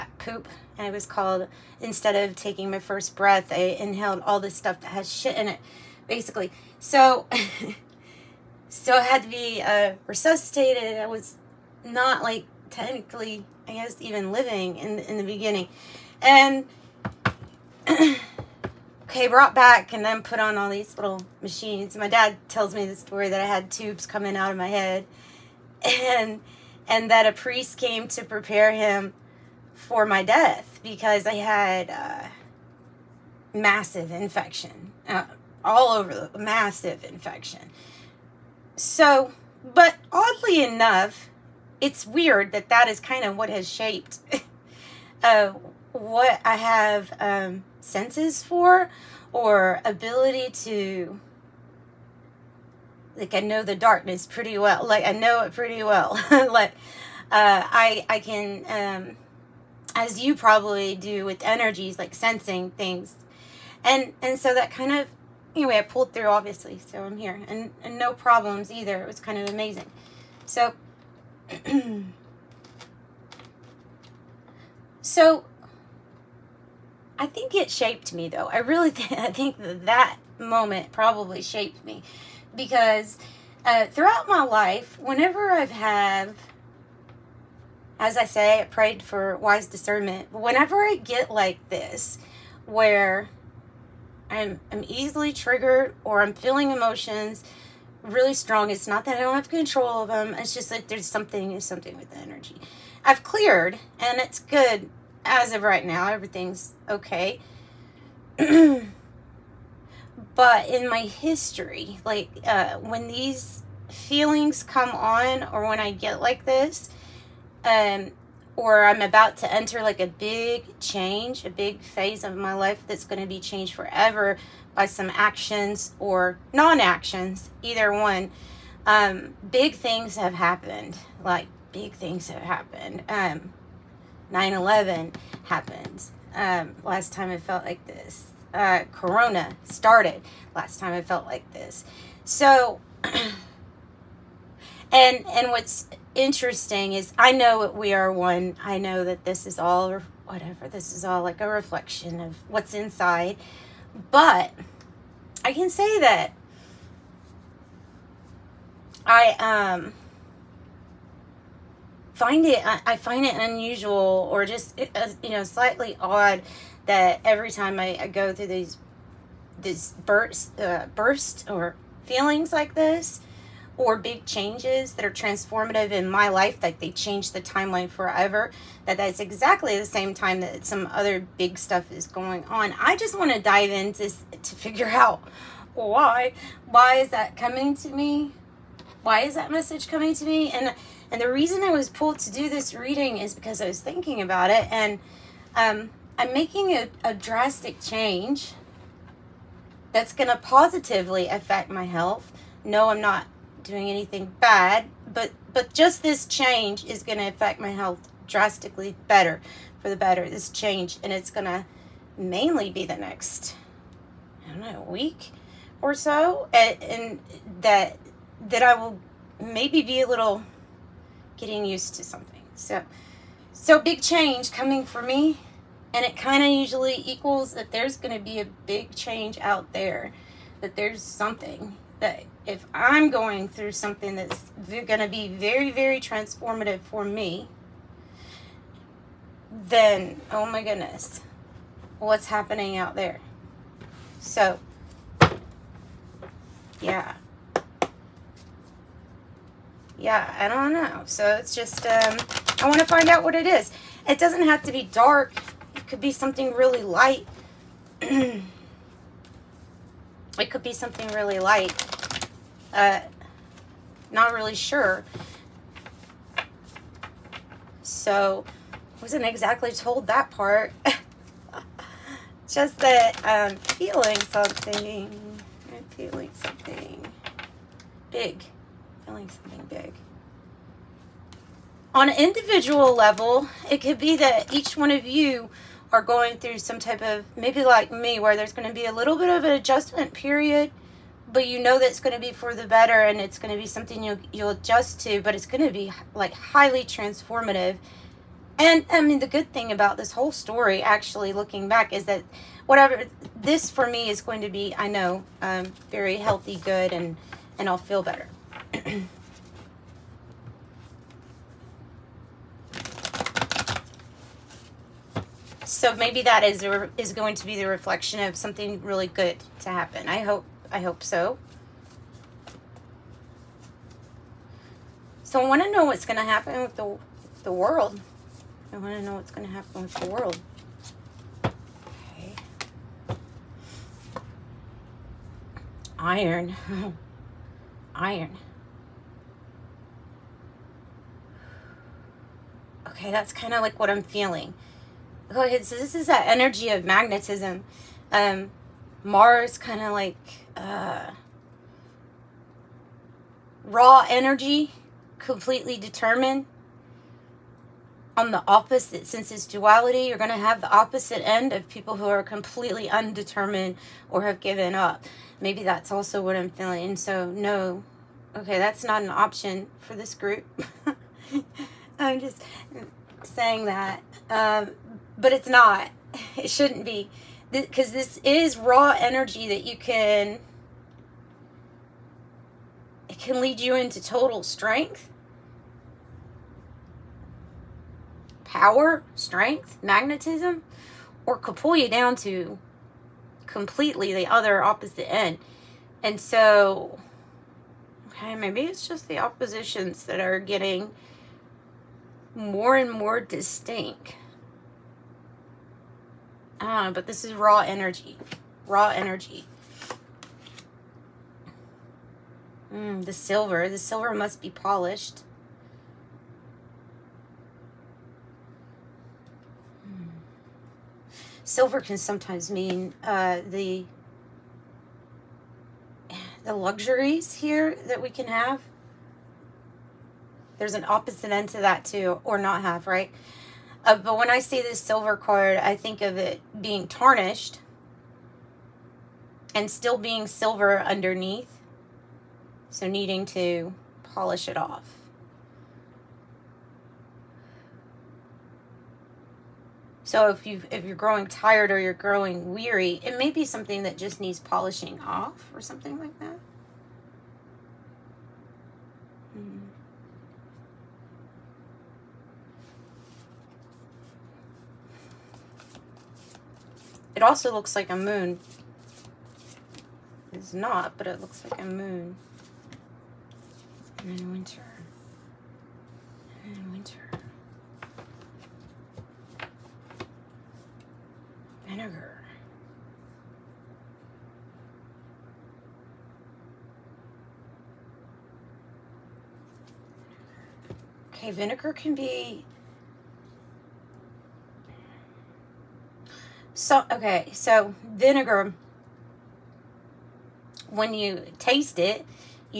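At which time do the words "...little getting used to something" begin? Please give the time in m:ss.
3:40.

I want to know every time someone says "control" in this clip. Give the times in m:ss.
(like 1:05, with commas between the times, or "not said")
1:39.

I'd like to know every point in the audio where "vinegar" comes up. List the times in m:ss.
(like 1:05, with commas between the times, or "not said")
8:01, 8:11, 8:17.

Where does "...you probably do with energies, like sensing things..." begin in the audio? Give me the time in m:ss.
1:00.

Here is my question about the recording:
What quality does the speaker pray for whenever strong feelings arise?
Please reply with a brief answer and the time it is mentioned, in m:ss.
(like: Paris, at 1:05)
Wise discernment, at 1:29.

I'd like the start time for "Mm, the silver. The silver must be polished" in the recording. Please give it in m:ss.
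6:52.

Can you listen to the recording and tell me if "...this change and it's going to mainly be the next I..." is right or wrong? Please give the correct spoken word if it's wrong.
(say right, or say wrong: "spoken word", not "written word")
right.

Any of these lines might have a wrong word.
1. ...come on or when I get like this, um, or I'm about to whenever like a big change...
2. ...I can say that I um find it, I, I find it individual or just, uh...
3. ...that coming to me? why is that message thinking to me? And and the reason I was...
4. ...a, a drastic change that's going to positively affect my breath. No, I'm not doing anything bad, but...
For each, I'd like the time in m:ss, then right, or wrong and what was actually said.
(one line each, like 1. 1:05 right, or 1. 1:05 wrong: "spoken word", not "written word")
1. 1:54 wrong: "enter", not "whenever"
2. 2:35 wrong: "unusual", not "individual"
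3. 3:07 wrong: "coming", not "thinking"
4. 3:16 wrong: "health", not "breath".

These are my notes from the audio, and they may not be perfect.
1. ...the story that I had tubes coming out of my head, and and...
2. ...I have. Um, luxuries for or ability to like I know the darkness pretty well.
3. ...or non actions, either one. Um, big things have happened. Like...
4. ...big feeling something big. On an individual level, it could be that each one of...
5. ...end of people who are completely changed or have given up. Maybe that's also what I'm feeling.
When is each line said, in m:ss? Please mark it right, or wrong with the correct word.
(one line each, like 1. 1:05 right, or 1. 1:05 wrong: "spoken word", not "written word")
1. 0:22 right
2. 0:46 wrong: "senses", not "luxuries"
3. 2:05 right
4. 4:38 right
5. 6:01 wrong: "undetermined", not "changed".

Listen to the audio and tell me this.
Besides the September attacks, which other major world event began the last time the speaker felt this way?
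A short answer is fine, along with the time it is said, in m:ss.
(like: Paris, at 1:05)
Corona, at 2:18.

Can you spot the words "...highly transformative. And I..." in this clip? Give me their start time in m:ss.
4:56.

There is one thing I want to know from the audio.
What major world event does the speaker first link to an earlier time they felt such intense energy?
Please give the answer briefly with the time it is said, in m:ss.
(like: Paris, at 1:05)
9-11, at 2:14.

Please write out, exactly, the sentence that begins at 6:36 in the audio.
And so, okay, maybe it's just the oppositions that are getting more and more distinct.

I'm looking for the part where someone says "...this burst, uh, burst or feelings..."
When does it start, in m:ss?
2:49.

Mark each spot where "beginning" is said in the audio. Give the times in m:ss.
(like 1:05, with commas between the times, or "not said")
0:15.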